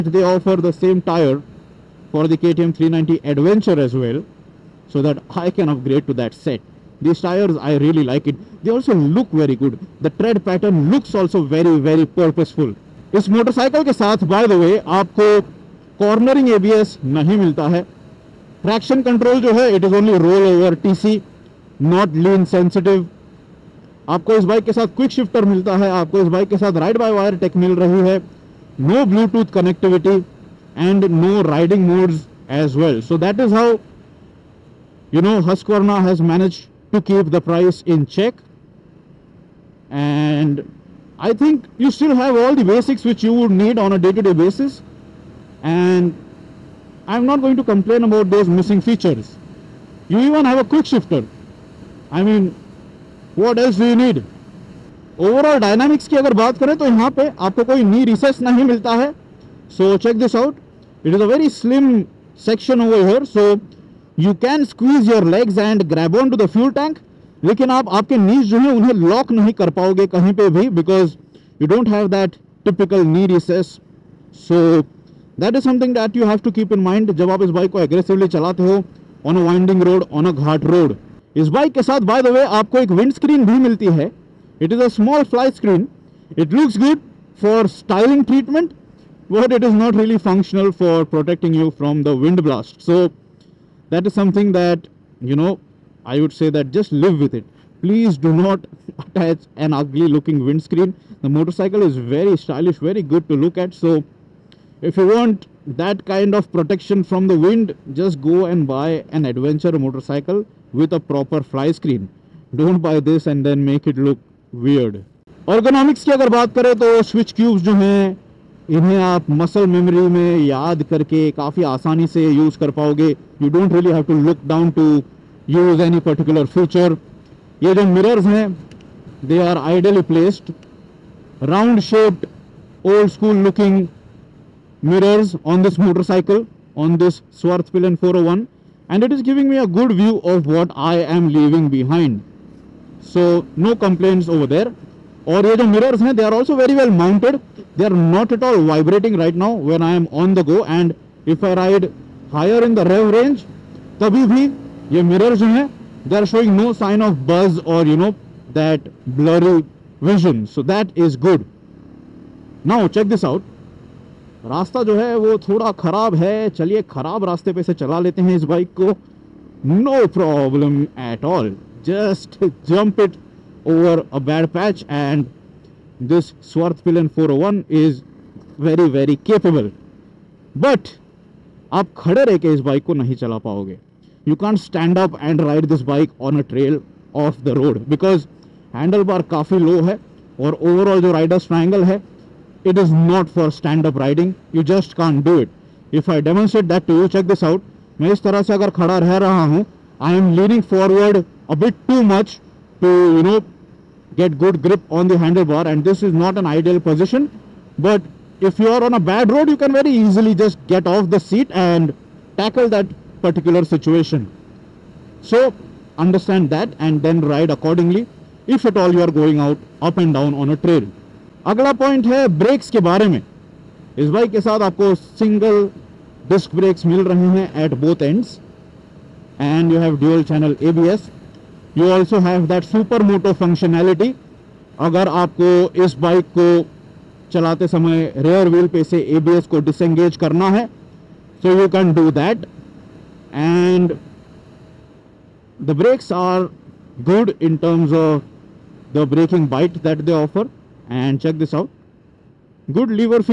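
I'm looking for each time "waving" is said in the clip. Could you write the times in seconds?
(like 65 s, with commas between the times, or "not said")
not said.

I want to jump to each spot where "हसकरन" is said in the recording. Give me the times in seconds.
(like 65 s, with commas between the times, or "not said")
35 s.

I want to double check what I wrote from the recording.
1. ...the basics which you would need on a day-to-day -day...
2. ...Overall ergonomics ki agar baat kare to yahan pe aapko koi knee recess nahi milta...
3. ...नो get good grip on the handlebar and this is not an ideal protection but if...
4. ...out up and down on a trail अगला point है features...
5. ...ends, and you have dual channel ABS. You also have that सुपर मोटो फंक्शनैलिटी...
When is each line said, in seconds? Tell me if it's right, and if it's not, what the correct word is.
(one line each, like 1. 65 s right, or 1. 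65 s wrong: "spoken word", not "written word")
1. 42 s right
2. 55 s wrong: "dynamics", not "ergonomics"
3. 203 s wrong: "position", not "protection"
4. 219 s wrong: "brakes", not "features"
5. 228 s right.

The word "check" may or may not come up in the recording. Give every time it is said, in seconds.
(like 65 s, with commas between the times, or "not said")
38 s, 60 s, 197 s, 251 s.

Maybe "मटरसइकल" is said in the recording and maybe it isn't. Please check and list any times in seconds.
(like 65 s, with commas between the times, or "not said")
13 s, 135 s.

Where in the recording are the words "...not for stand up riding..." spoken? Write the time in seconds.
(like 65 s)
193 s.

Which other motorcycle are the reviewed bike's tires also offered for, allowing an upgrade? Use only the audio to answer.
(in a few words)
KTM 390 Adventure.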